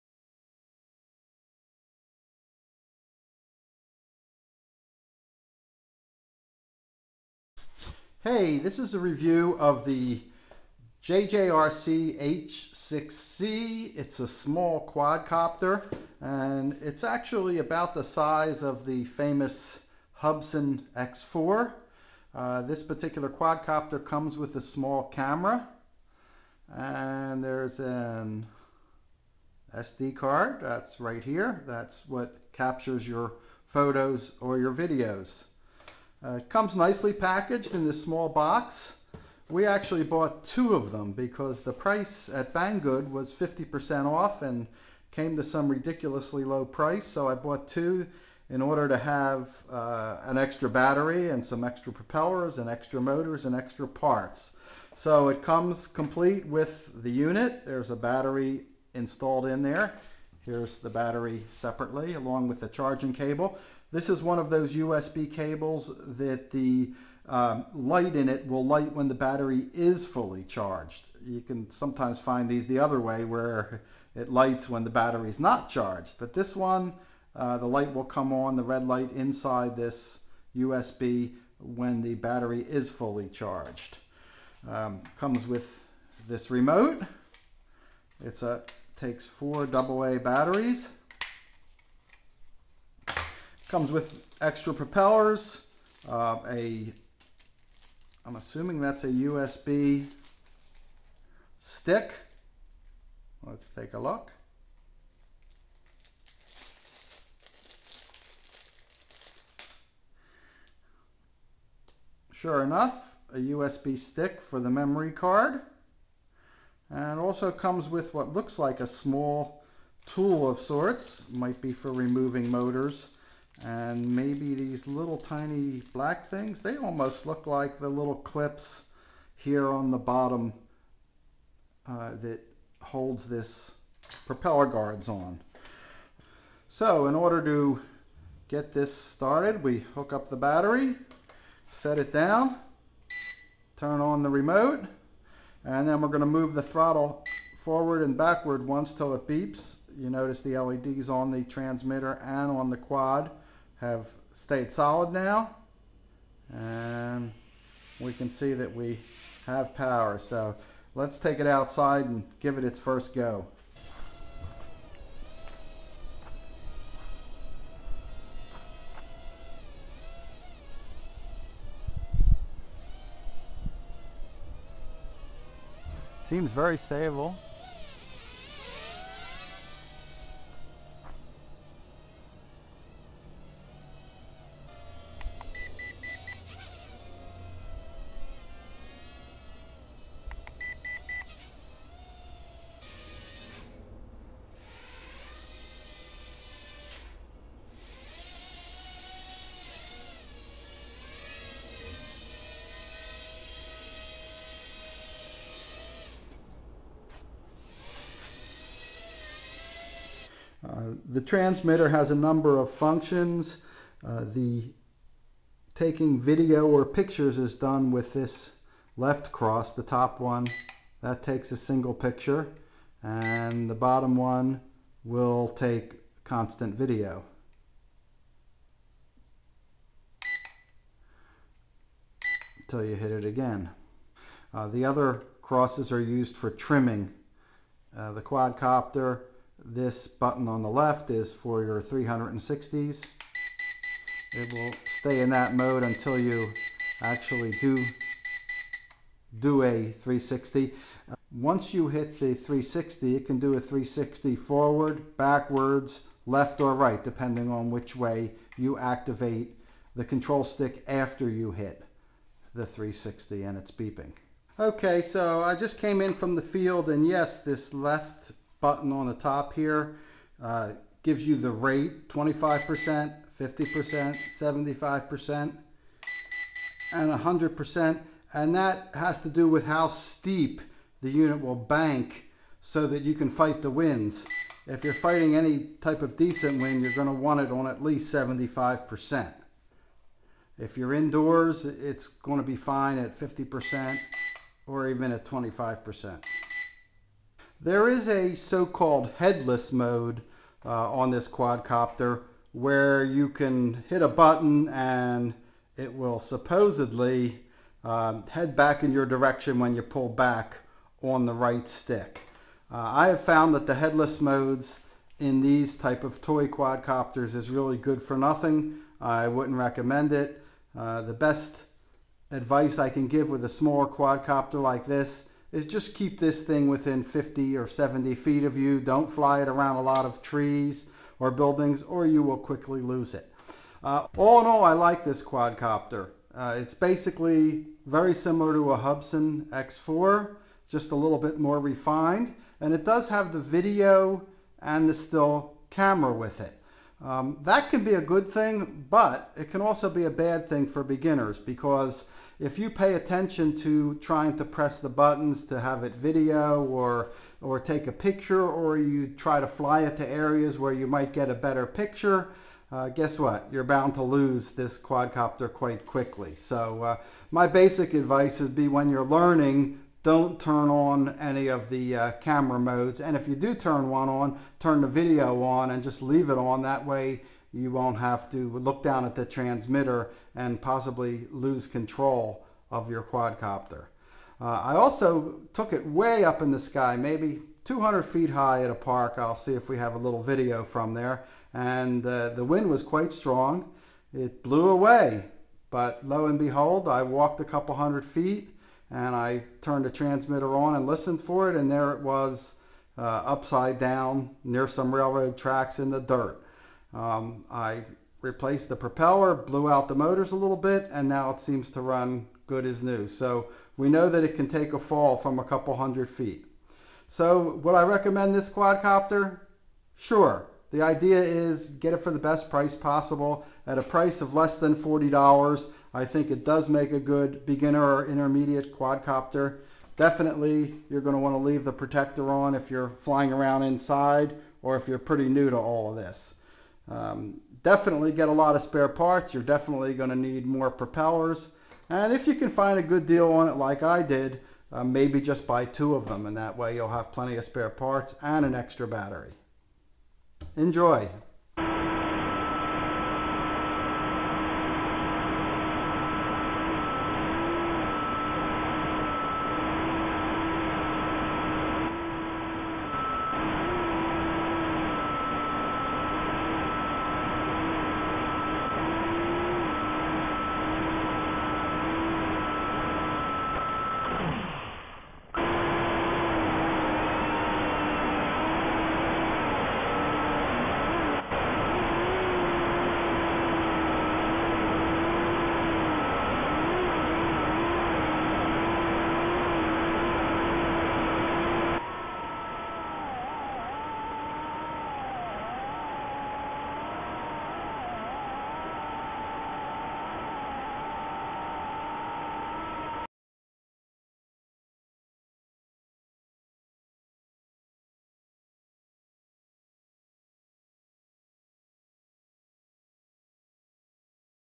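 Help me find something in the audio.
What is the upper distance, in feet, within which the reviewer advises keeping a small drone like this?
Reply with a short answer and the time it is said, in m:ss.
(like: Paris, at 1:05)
70 feet, at 5:27.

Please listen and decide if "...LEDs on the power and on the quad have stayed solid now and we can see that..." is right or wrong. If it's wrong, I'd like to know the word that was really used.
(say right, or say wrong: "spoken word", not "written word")
wrong: "transmitter", not "power".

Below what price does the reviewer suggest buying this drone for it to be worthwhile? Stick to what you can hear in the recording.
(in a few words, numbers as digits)
$40.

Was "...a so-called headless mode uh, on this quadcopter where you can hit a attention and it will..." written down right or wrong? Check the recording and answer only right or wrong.
wrong.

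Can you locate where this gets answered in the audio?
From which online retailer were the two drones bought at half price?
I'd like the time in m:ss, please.
0:42.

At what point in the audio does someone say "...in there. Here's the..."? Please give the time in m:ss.
0:59.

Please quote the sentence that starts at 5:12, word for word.
Uh, I have found that the headless modes in these type of toy quadcopters is really good for nothing.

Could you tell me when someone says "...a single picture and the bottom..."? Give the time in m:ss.
3:41.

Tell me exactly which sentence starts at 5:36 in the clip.
Uh, it's basically very similar to a Hubsan X4, just a little bit more refined.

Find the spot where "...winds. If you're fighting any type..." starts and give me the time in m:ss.
4:43.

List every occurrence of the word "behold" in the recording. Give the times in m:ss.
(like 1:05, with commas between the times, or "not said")
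6:36.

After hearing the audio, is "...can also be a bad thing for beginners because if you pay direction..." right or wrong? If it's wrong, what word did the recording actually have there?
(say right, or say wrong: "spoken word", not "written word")
wrong: "attention", not "direction".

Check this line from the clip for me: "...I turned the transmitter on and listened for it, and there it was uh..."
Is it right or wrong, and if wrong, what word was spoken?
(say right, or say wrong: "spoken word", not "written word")
right.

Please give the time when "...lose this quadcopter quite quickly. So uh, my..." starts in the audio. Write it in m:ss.
6:04.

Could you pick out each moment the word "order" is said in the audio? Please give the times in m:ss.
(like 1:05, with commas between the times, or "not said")
0:48, 2:17.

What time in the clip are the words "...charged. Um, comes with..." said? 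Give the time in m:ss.
1:23.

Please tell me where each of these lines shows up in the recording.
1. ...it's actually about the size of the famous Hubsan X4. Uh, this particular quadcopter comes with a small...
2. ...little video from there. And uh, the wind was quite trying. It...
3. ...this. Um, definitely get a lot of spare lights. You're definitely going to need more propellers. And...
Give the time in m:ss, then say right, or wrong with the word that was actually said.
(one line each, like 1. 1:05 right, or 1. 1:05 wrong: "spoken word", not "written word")
1. 0:16 right
2. 6:29 wrong: "strong", not "trying"
3. 7:15 wrong: "parts", not "lights".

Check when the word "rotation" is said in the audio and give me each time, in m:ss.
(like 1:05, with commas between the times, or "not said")
not said.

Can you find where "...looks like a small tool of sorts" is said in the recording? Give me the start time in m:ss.
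1:58.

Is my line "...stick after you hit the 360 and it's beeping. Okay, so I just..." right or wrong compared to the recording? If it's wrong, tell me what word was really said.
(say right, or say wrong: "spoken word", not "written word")
right.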